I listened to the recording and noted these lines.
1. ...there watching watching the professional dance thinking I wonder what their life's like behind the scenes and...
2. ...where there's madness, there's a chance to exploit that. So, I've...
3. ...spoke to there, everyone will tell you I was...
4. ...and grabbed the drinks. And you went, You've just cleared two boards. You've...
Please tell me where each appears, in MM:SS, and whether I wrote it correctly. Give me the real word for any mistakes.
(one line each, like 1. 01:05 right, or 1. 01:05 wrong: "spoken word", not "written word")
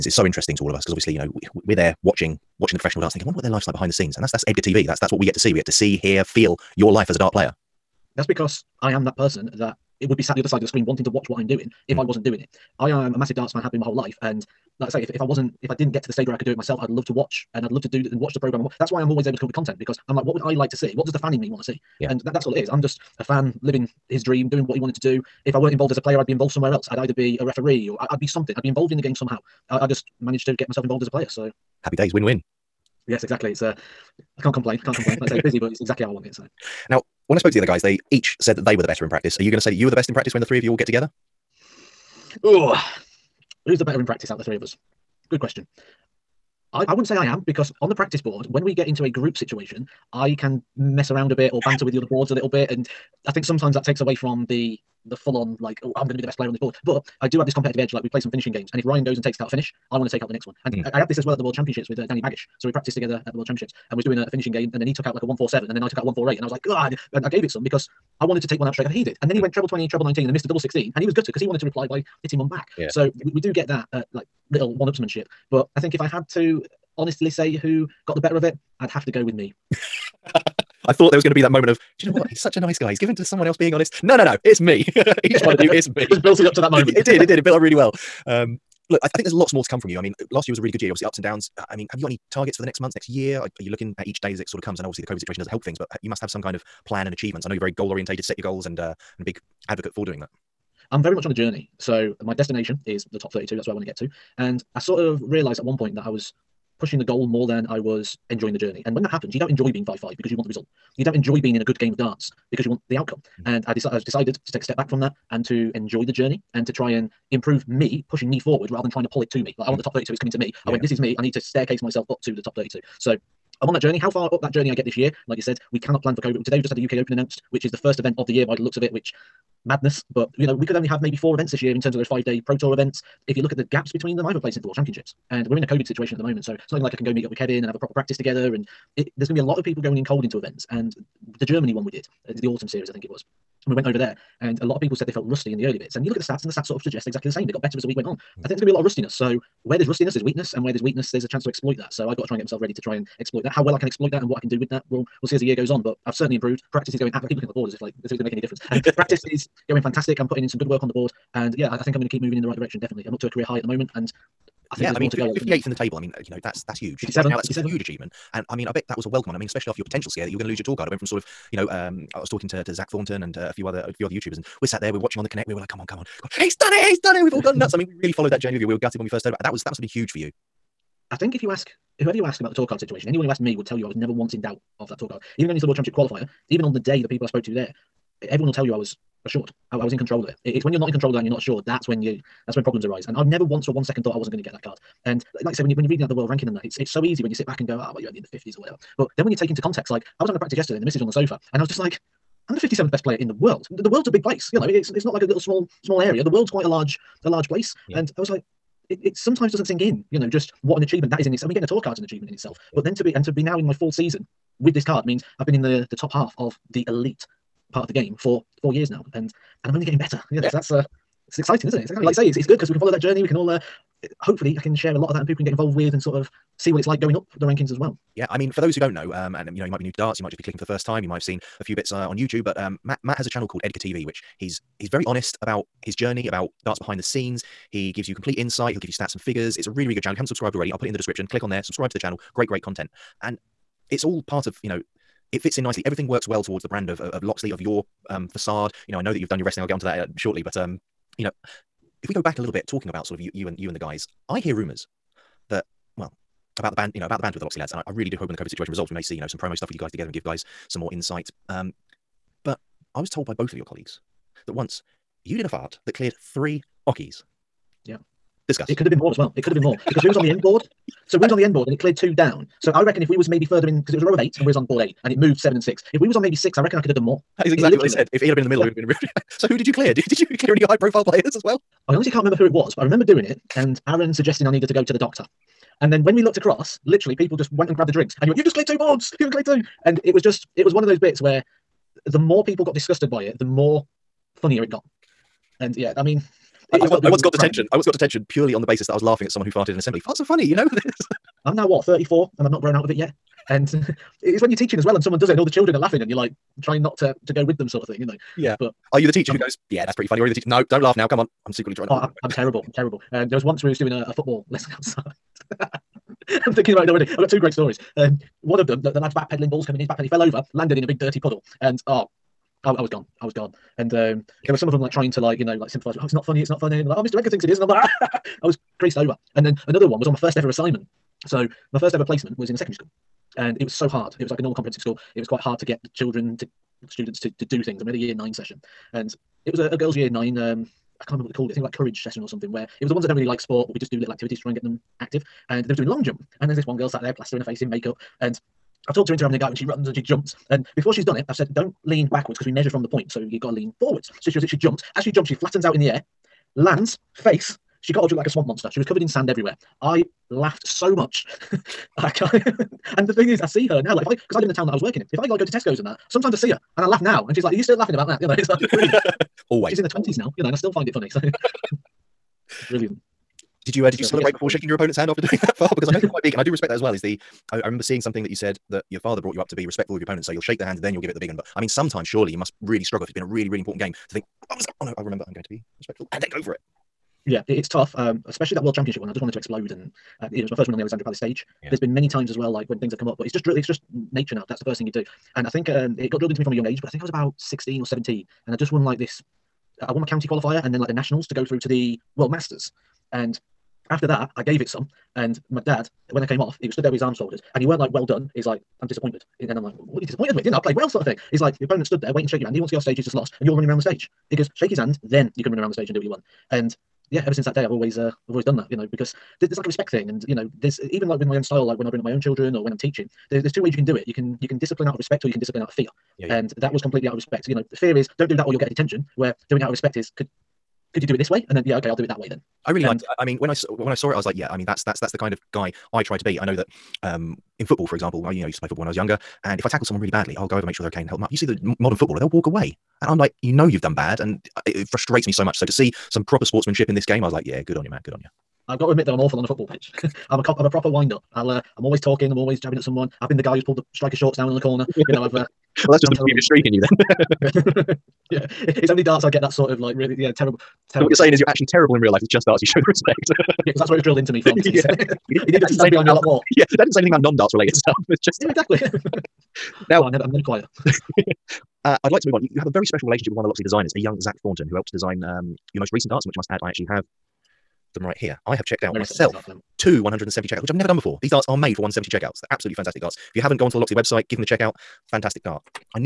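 1. 00:01 right
2. 02:30 wrong: "weakness", not "madness"
3. 03:07 right
4. 04:47 right.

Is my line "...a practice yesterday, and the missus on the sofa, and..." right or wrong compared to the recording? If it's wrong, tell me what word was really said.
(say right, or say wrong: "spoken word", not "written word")
right.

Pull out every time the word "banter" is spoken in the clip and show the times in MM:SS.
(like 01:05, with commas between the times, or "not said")
00:51.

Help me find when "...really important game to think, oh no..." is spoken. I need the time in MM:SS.
06:23.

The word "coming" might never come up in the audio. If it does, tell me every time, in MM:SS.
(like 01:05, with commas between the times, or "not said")
02:00, 05:19.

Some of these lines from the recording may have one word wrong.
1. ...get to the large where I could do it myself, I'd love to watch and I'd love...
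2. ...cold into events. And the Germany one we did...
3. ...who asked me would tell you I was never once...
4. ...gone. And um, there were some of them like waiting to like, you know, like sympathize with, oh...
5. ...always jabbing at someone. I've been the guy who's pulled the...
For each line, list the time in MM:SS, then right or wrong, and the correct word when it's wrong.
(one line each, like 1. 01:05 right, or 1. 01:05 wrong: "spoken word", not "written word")
1. 00:15 wrong: "stage", not "large"
2. 02:20 right
3. 03:03 right
4. 05:23 wrong: "trying", not "waiting"
5. 07:32 right.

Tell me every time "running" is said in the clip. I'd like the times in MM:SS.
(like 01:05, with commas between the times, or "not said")
06:53.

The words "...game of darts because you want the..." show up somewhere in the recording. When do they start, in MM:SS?
01:51.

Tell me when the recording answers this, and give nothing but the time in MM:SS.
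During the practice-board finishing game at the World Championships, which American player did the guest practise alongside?
01:02.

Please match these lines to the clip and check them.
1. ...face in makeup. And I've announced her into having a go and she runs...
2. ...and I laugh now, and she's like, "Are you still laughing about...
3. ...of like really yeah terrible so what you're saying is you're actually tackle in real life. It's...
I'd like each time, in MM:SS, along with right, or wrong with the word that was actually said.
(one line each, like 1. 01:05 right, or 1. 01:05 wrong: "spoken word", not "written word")
1. 05:47 wrong: "talked", not "announced"
2. 06:06 right
3. 07:39 wrong: "terrible", not "tackle".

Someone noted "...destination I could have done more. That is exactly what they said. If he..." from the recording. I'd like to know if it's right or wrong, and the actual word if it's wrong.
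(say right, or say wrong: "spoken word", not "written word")
wrong: "reckon", not "destination".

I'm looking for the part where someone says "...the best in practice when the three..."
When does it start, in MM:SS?
00:39.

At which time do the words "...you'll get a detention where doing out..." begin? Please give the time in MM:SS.
07:08.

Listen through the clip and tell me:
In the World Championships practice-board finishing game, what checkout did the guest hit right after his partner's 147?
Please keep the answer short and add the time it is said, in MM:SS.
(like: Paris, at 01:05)
148, at 01:06.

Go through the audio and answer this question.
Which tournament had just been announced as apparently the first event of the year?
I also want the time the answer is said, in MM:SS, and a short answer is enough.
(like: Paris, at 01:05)
UK Open, at 02:06.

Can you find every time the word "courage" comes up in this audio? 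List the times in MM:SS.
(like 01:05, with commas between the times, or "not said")
05:41.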